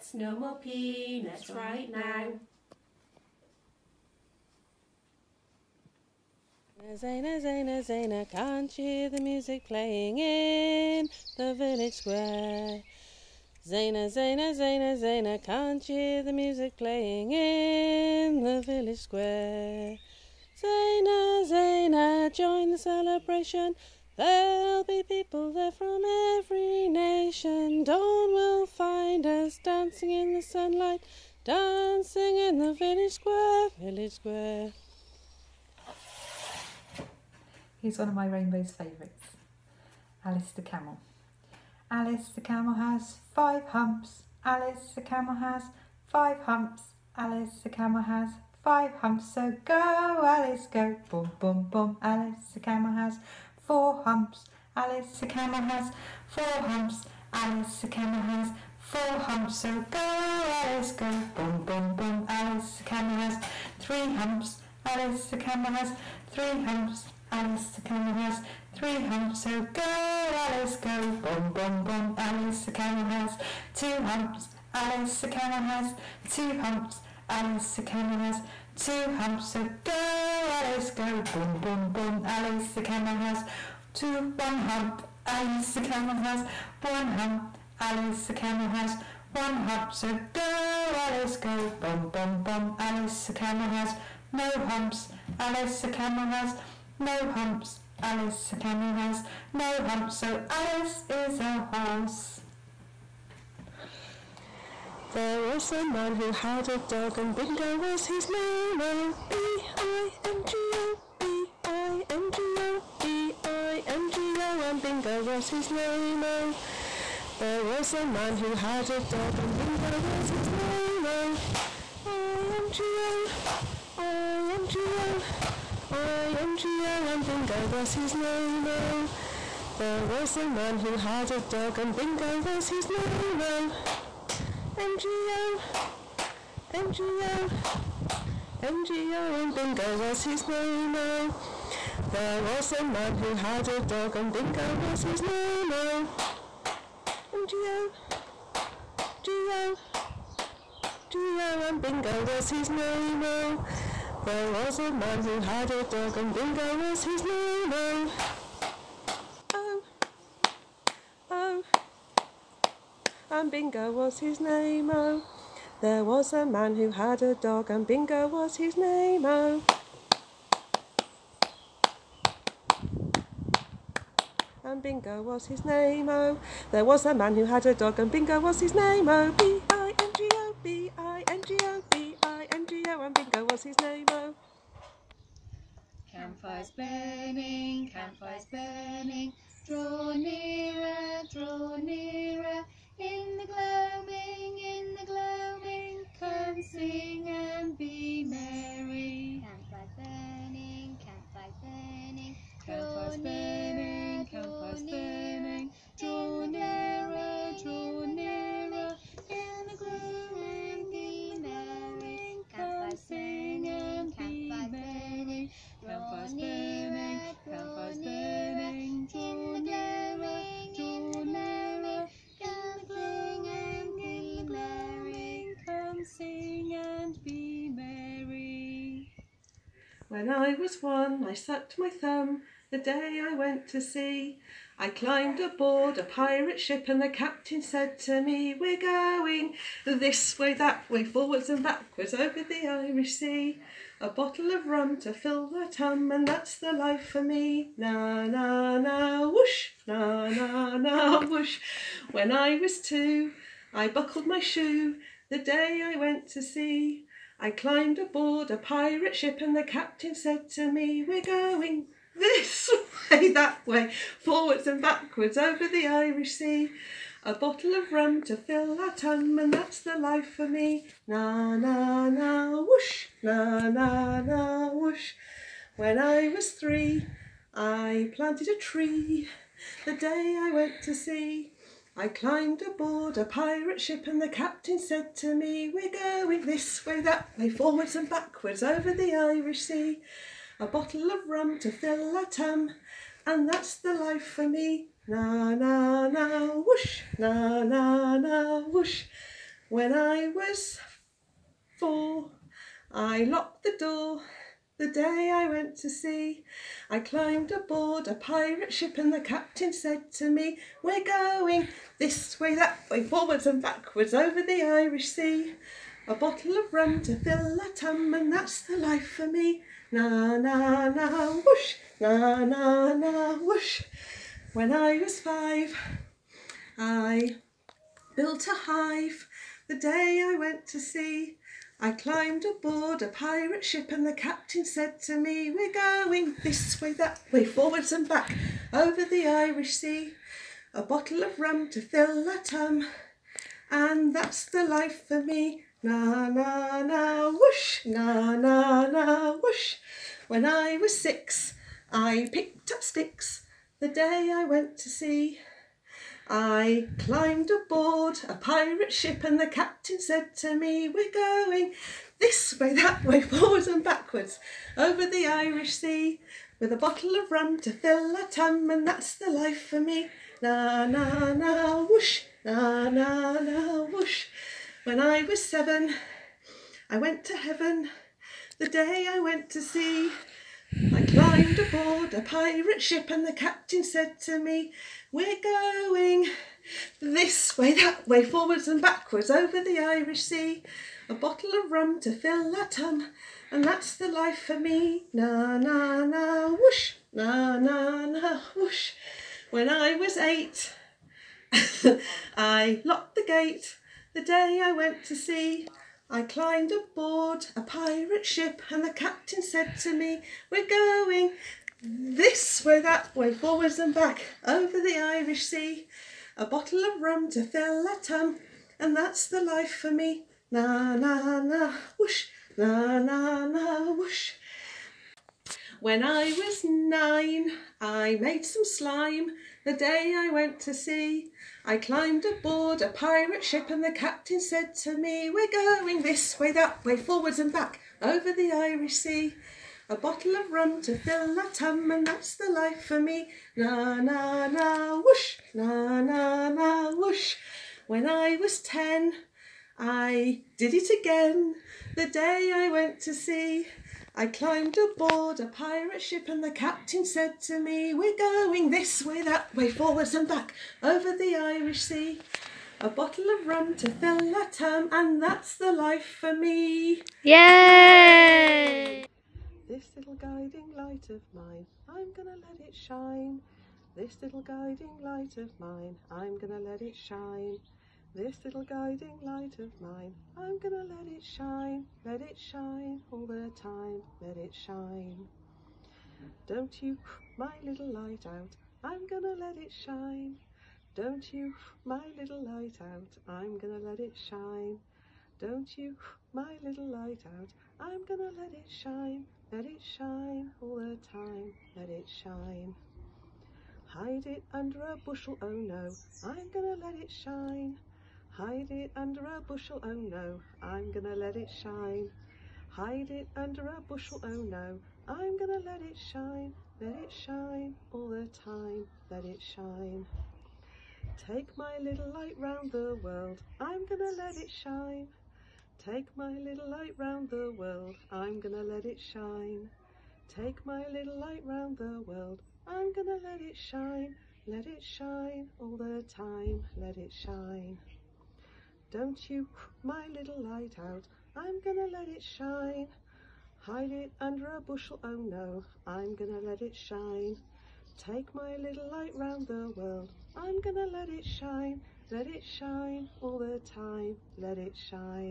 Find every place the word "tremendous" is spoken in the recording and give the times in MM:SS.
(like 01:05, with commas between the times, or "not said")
not said.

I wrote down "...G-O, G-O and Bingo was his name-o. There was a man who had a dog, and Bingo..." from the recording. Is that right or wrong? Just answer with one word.
right.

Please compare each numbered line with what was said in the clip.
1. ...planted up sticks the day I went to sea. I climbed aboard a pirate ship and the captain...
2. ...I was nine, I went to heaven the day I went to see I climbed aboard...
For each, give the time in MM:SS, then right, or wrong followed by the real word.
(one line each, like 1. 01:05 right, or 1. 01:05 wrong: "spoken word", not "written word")
1. 05:52 wrong: "picked", not "planted"
2. 06:14 wrong: "seven", not "nine".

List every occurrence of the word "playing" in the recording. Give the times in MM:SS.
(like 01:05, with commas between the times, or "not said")
00:09, 00:16.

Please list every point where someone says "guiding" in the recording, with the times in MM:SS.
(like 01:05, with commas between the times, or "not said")
07:50, 07:54, 07:58.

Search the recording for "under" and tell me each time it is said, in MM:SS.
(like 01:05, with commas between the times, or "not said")
08:24, 08:28, 08:33, 09:04.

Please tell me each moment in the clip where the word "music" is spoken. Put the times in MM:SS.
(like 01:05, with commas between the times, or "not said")
00:09, 00:16.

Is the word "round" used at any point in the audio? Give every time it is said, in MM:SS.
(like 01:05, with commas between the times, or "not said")
08:42, 08:46, 08:51, 09:09.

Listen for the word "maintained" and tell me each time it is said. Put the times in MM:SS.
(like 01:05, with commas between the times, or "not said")
not said.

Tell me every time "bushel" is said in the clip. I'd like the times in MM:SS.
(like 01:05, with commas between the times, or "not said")
08:24, 08:29, 08:33, 09:04.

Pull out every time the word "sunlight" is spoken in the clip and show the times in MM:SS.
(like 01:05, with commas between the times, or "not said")
00:30.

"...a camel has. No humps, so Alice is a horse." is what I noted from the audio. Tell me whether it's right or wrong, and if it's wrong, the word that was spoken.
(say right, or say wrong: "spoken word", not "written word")
right.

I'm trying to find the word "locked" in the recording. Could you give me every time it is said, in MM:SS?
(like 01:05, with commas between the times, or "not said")
05:03, 06:42.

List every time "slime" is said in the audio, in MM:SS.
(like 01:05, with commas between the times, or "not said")
07:08.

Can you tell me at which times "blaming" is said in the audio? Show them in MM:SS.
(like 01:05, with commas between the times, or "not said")
not said.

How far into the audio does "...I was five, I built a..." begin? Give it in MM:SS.
05:24.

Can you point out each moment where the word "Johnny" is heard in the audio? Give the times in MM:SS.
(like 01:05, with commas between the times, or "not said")
not said.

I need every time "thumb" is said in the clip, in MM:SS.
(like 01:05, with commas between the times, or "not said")
03:51.